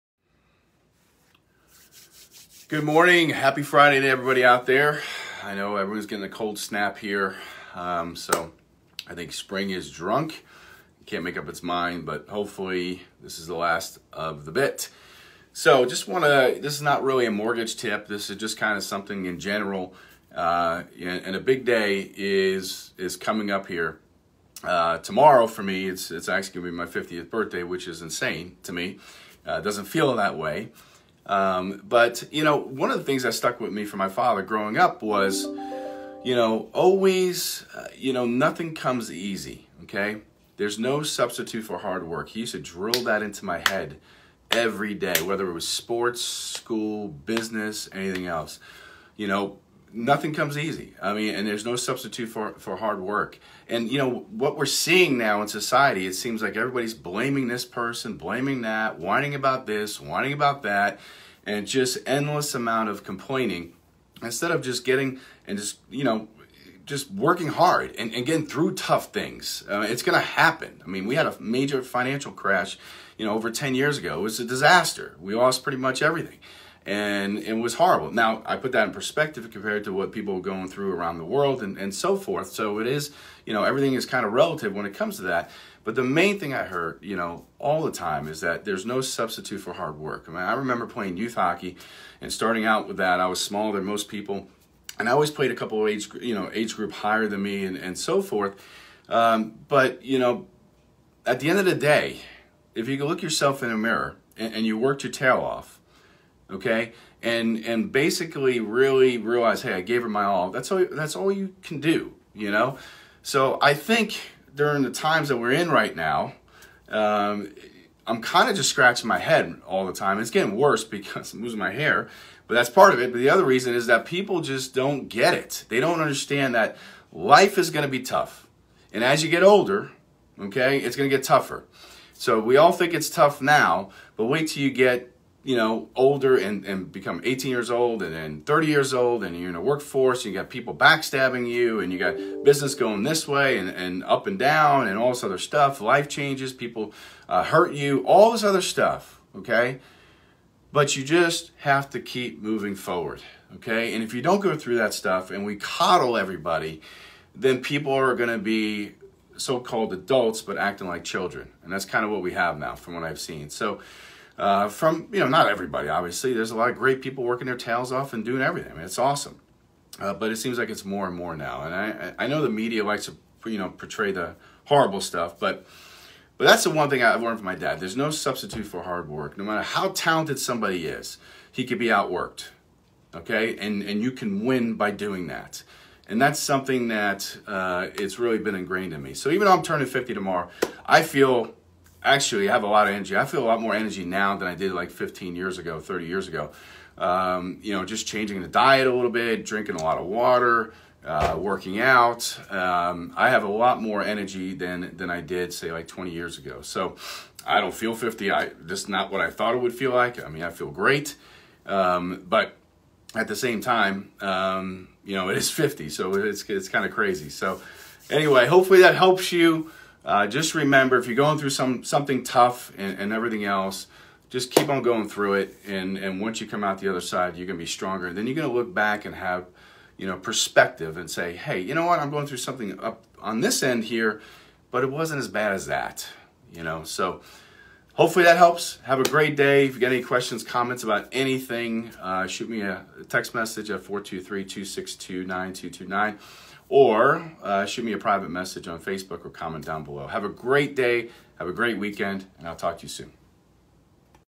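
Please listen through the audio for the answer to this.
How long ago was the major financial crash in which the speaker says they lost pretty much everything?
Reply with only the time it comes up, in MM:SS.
01:13.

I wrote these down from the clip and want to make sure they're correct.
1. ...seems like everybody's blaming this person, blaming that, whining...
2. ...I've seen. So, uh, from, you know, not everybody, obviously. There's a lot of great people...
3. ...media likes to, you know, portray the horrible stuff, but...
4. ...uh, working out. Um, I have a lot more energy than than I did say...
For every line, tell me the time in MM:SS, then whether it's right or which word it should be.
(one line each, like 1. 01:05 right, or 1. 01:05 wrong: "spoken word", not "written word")
1. 00:56 right
2. 02:43 right
3. 02:52 right
4. 03:21 right.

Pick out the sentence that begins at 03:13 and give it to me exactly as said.
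I feel a lot more energy now than I did like 15 years ago, 30 years ago.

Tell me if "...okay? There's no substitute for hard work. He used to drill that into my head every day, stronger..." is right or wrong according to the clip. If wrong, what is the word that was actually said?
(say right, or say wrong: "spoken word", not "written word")
wrong: "whether", not "stronger".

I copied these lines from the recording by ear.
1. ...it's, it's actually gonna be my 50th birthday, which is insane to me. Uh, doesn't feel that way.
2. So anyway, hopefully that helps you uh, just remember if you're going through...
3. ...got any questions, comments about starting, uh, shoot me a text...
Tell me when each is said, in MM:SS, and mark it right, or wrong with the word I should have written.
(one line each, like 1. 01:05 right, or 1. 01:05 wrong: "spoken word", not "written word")
1. 00:25 right
2. 03:37 right
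3. 03:59 wrong: "anything", not "starting".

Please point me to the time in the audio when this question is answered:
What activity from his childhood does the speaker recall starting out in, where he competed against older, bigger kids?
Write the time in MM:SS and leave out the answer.
01:31.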